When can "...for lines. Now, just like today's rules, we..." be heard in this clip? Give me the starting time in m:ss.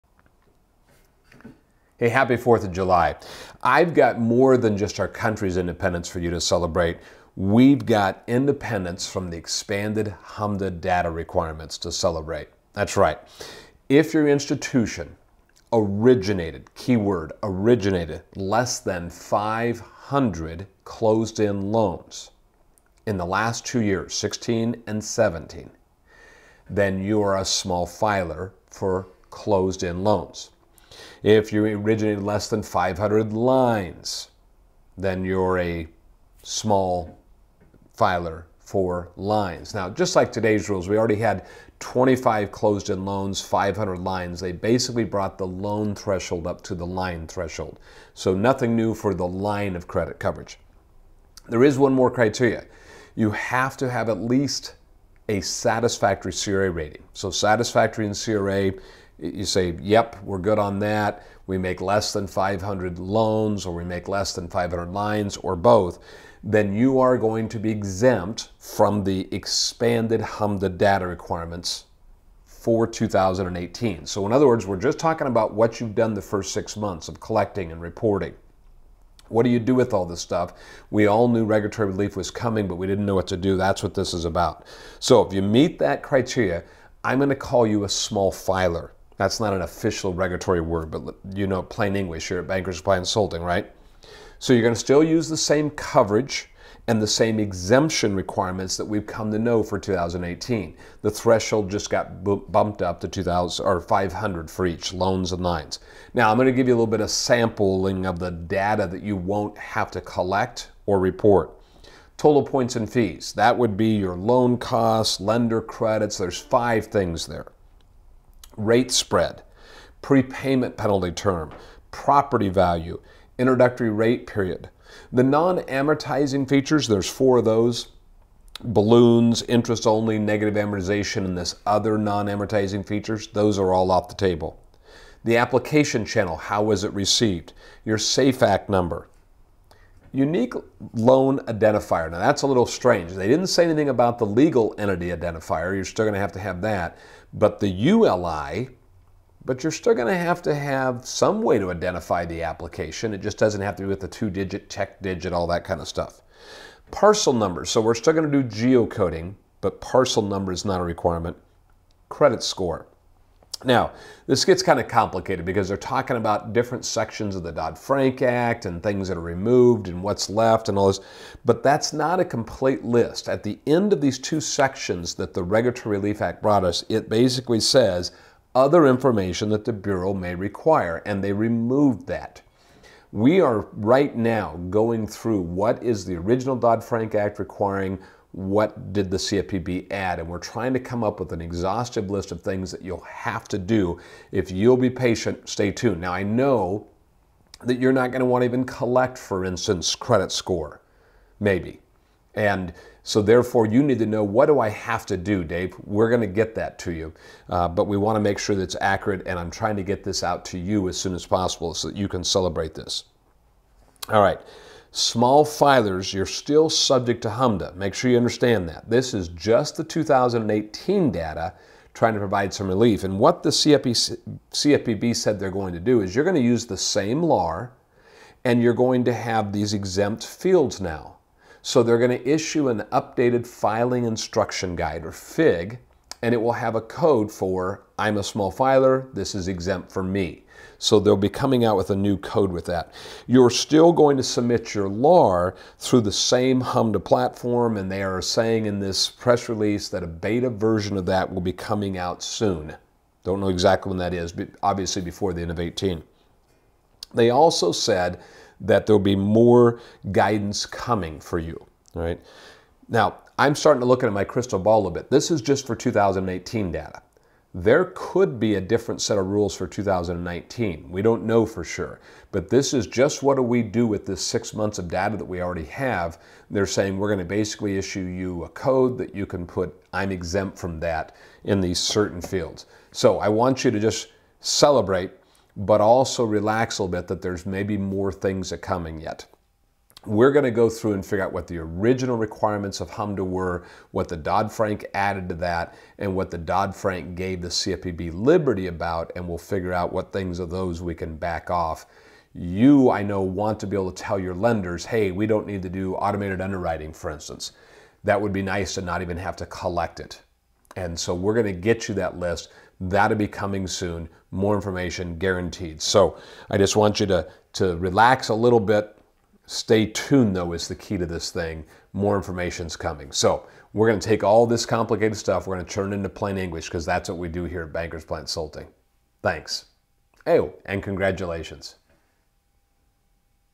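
0:38.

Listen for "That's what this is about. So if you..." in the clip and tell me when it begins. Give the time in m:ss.
1:23.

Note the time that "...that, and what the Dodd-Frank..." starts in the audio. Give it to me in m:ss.
4:55.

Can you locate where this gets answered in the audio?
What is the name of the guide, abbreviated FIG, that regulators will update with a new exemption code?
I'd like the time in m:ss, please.
3:53.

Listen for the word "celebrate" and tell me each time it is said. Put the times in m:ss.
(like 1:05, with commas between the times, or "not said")
0:06, 0:11, 3:32, 4:44.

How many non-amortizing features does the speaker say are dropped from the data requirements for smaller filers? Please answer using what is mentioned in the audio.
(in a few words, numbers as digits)
4.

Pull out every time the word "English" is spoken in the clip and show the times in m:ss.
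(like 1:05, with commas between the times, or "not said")
1:31, 5:26.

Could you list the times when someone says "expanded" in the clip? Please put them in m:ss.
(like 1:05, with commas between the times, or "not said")
0:09, 1:09.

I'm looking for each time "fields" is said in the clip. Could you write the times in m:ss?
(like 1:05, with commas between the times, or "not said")
3:50, 4:42.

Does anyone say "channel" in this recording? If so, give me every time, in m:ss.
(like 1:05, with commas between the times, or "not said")
2:16.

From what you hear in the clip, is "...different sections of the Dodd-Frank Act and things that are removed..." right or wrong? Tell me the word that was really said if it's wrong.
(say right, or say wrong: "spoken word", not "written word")
right.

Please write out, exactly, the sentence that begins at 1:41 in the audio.
The threshold just got bumped up to 2000 or 500 for each loans and lines.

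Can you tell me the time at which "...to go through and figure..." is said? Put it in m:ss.
4:50.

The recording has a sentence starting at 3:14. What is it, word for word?
If you'll be patient, stay tuned.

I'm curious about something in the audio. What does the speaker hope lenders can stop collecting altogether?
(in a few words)
Automated underwriting.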